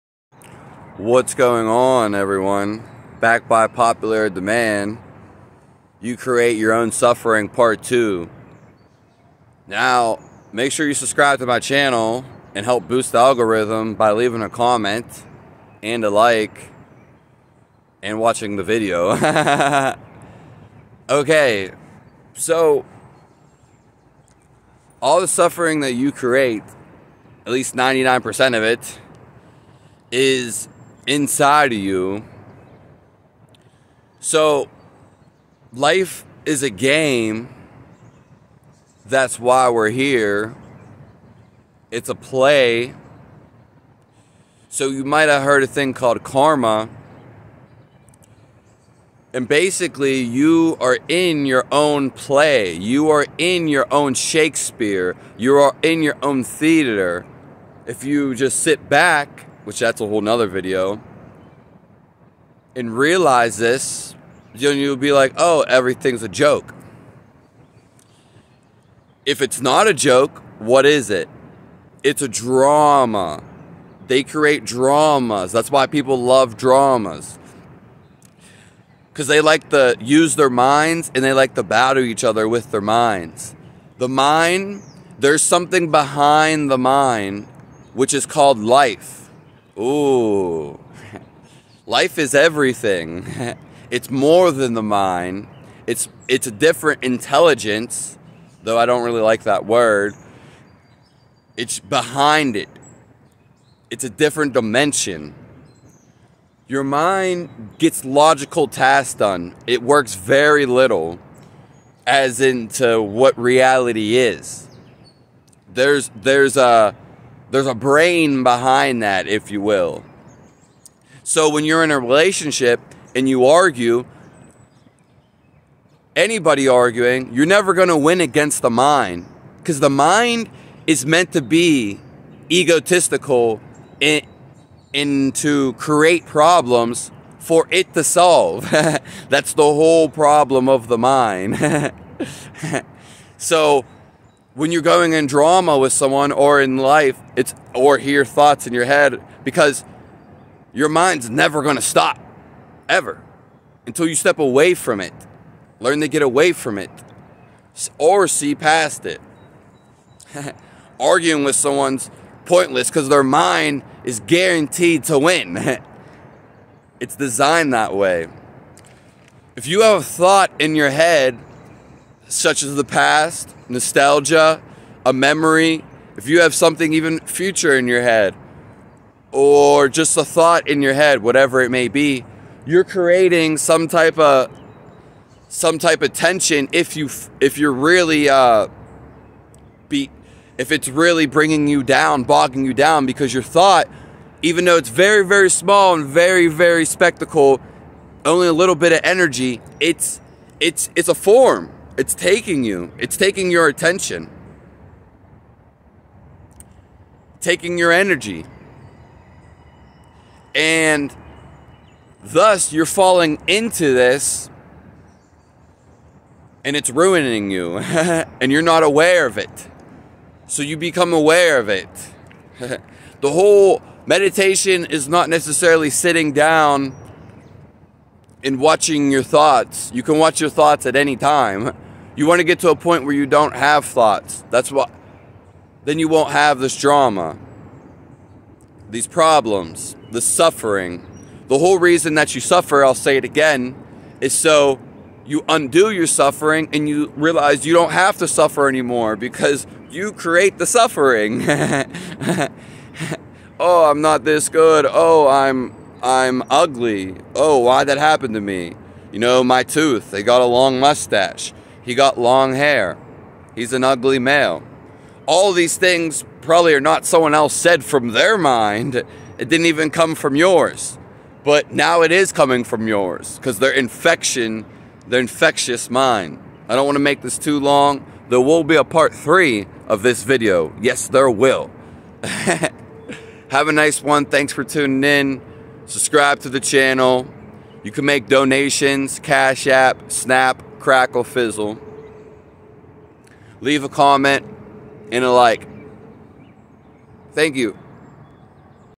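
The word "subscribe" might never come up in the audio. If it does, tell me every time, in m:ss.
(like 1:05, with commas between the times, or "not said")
0:10, 4:45.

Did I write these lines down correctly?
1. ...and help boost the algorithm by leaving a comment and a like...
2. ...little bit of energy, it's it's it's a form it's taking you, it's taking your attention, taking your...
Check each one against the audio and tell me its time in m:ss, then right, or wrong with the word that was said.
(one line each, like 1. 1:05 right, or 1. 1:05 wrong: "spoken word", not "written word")
1. 0:12 right
2. 3:18 right.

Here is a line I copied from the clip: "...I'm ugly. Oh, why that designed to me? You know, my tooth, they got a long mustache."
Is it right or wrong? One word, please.
wrong.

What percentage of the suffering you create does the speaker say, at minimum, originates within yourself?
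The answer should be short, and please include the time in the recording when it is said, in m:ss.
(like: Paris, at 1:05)
99%, at 0:27.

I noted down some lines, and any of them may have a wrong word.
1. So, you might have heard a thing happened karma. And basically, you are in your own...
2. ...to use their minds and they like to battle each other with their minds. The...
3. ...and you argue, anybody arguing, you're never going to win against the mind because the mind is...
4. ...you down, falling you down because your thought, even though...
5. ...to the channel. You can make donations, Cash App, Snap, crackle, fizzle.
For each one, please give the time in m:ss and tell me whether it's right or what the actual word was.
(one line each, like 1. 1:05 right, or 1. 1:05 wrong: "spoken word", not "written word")
1. 0:44 wrong: "called", not "happened"
2. 1:19 right
3. 2:03 right
4. 3:11 wrong: "bogging", not "falling"
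5. 4:46 right.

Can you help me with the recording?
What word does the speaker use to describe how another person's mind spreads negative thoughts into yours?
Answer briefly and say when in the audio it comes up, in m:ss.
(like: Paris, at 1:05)
Infectious, at 4:35.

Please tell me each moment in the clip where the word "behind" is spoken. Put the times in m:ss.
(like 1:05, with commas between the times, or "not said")
1:25, 1:41, 1:58.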